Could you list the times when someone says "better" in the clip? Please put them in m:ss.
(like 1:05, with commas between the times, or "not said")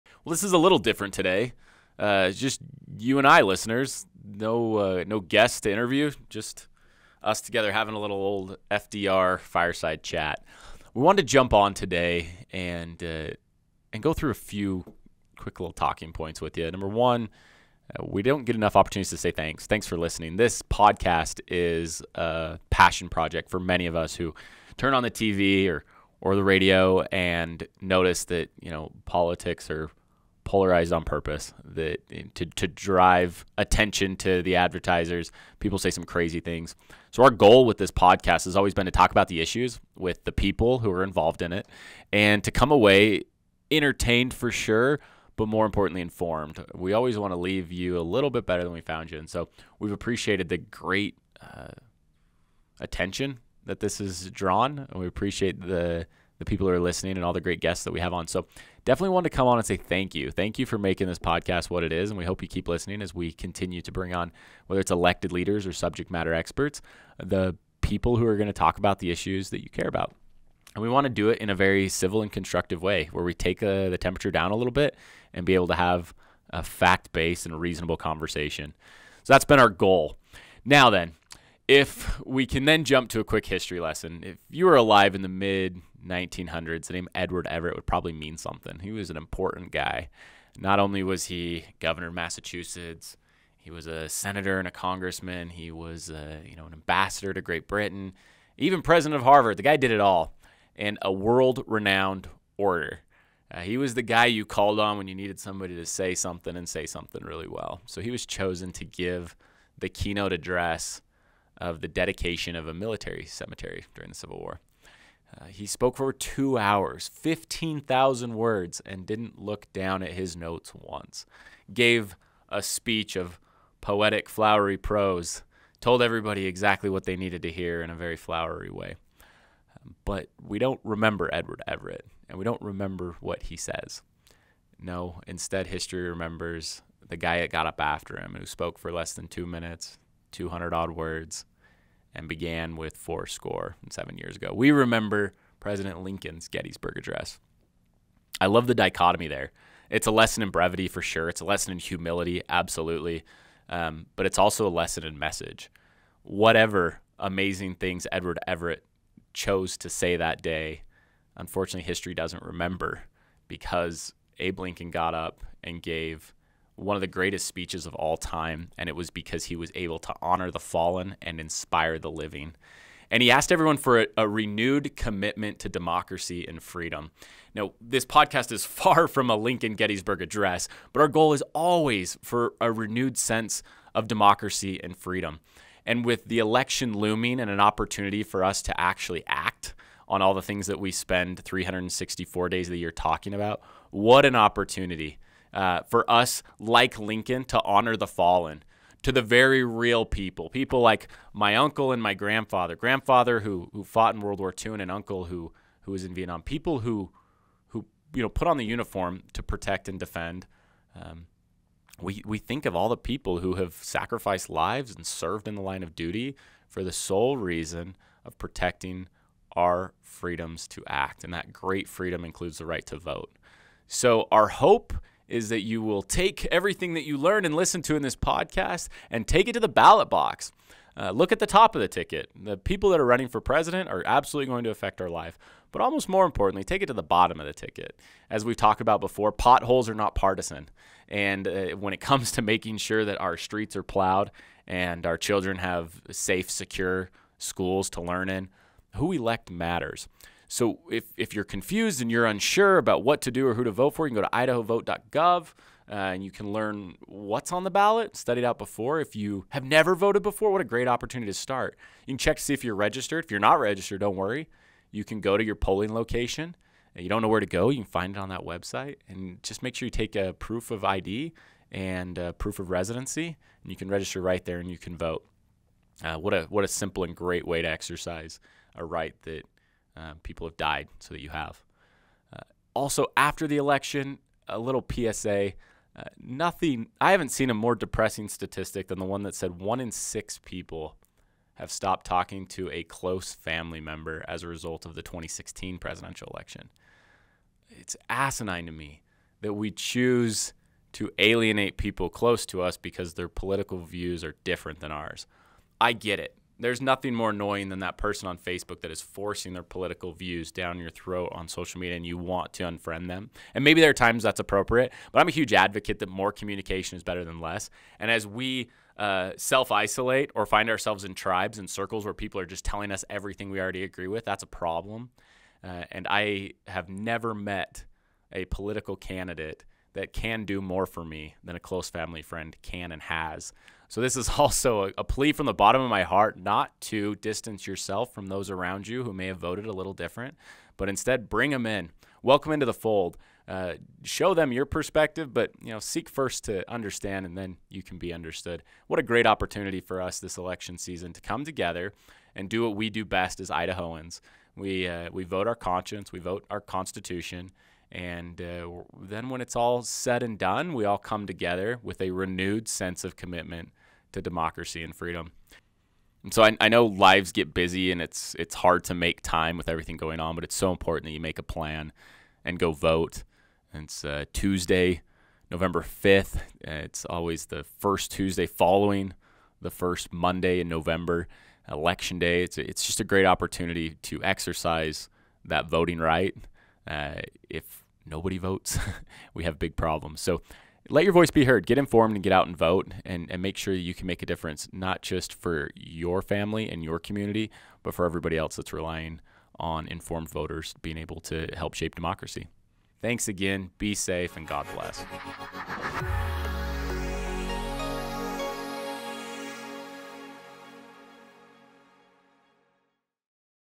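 0:48, 5:17.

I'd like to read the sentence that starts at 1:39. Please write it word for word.
The guy did it all, and a world-renowned orator.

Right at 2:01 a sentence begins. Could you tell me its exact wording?
Gave a speech of poetic, flowery prose, told everybody exactly what they needed to hear in a very flowery way.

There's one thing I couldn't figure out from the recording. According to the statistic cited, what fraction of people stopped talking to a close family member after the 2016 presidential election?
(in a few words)
1 in 6.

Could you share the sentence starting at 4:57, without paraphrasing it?
It's asinine to me that we choose to alienate people close to us because their political views are different than ours.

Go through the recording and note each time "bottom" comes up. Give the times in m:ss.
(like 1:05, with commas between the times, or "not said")
3:57, 5:35.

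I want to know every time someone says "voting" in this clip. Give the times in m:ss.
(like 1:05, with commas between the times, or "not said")
6:25.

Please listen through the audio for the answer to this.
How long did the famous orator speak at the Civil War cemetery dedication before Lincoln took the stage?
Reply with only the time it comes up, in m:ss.
1:56.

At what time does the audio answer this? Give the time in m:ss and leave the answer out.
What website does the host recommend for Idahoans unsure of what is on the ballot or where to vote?
4:14.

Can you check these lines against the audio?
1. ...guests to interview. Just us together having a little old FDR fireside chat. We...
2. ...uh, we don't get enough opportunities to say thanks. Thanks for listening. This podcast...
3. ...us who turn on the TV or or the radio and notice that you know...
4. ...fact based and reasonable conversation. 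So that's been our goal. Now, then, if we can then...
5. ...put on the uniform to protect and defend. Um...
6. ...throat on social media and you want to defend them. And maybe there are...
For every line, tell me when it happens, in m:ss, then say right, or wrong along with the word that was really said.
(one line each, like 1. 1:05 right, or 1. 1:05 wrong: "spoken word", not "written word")
1. 0:05 right
2. 0:17 right
3. 0:23 right
4. 1:16 right
5. 3:28 right
6. 5:10 wrong: "unfriend", not "defend".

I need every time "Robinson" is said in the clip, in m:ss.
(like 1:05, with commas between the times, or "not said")
not said.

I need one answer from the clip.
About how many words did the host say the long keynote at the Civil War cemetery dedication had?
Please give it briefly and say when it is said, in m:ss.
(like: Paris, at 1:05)
15,000, at 1:57.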